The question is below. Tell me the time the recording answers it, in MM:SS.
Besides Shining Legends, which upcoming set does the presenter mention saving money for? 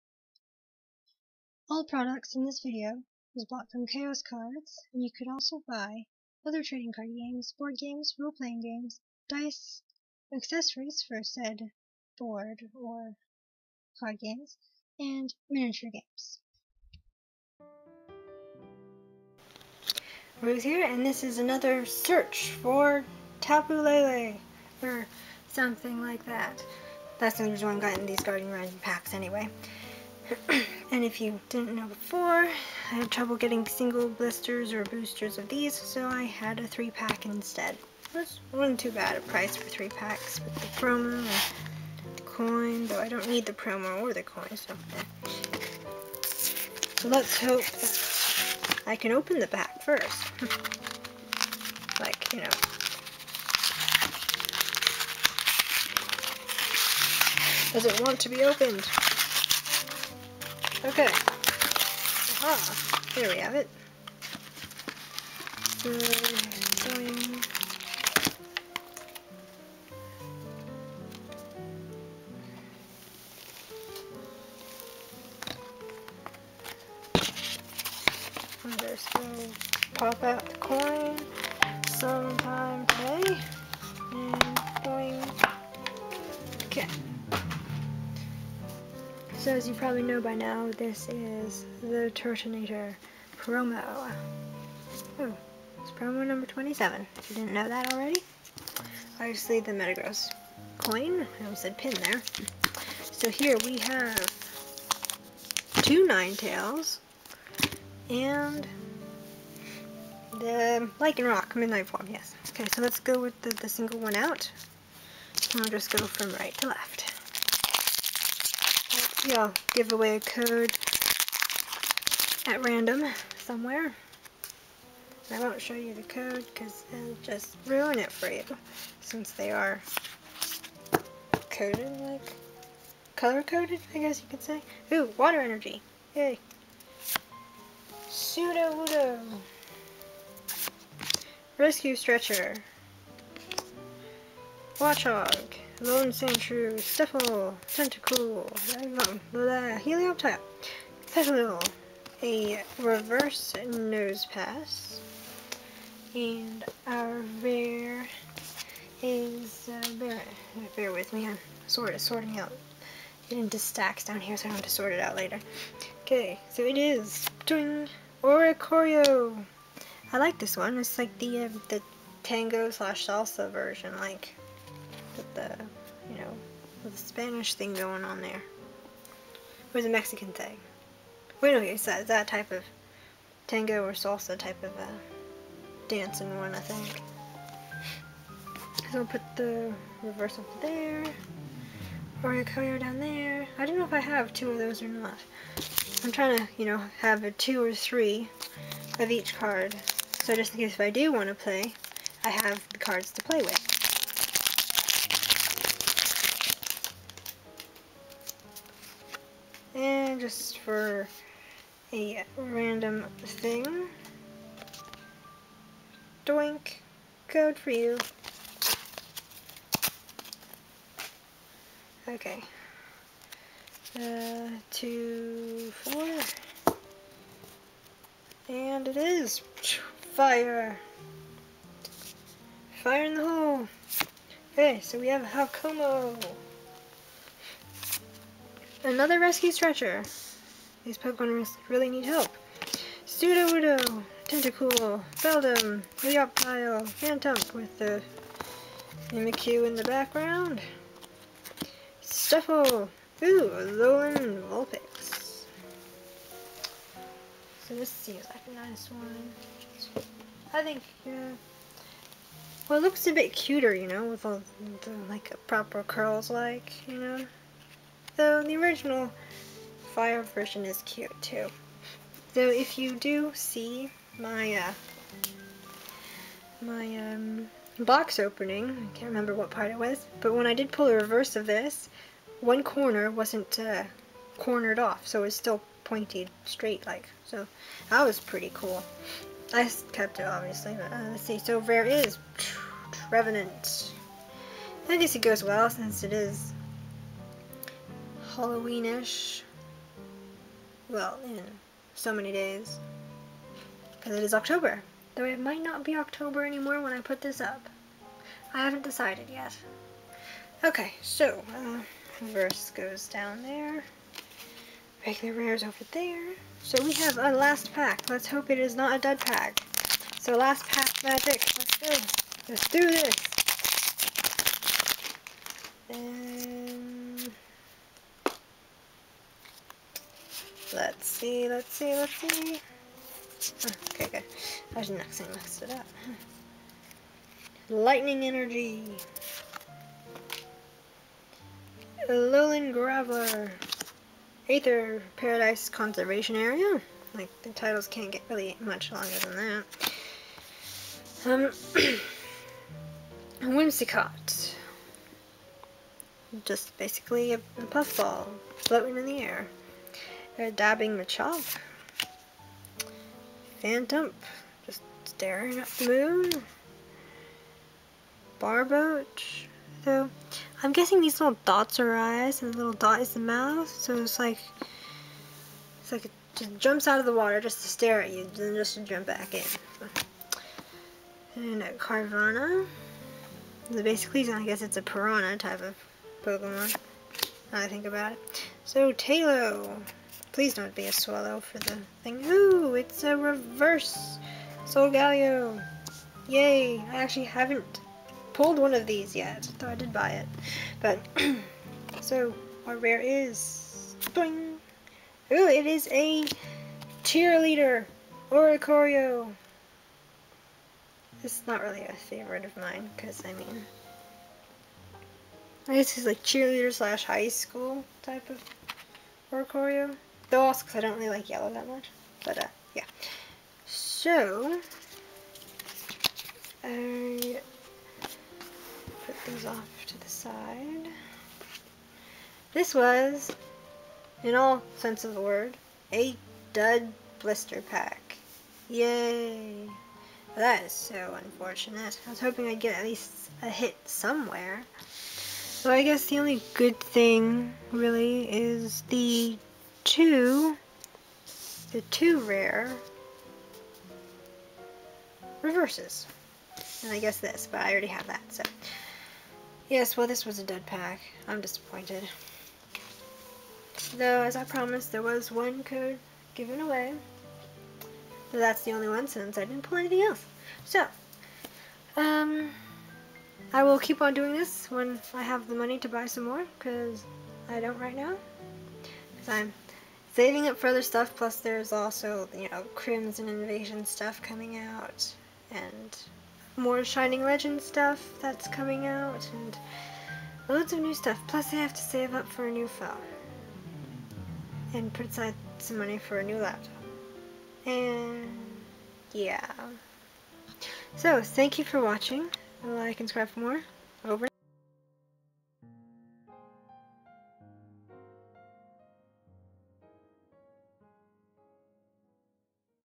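08:02.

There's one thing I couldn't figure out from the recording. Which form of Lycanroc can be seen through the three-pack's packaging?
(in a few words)
Midnight Form.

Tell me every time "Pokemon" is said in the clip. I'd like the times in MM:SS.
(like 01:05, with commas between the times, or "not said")
04:00, 06:26.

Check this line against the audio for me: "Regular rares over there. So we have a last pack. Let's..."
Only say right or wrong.
right.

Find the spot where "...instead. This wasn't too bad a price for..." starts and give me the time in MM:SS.
00:37.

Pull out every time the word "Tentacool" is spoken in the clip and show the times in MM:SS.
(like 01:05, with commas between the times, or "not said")
02:27, 04:04.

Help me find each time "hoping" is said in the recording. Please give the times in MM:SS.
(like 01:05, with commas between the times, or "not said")
07:22.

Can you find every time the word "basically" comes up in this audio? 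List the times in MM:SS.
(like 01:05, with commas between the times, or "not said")
05:56, 06:23.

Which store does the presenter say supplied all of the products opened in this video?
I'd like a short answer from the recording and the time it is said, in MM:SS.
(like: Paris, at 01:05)
Chaos Cards, at 00:03.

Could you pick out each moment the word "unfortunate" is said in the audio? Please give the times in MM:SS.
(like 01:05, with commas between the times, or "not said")
07:21.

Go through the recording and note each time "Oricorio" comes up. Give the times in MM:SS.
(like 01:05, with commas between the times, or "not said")
02:48, 03:12, 06:48, 06:59.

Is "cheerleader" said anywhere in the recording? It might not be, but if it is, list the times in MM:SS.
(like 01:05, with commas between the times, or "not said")
06:47, 06:56.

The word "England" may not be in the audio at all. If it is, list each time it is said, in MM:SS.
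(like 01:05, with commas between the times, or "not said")
not said.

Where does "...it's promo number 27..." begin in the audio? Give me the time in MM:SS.
01:35.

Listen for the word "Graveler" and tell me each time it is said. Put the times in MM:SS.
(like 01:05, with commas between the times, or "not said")
05:42.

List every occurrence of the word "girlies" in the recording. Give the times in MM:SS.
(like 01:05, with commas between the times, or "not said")
not said.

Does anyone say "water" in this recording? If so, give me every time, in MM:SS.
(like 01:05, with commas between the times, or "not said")
02:15, 06:17.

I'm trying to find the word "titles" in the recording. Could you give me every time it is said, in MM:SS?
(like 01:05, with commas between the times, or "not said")
05:47.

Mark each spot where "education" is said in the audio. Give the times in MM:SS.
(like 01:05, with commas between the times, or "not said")
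not said.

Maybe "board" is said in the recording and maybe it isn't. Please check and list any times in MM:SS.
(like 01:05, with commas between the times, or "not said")
00:07, 00:12.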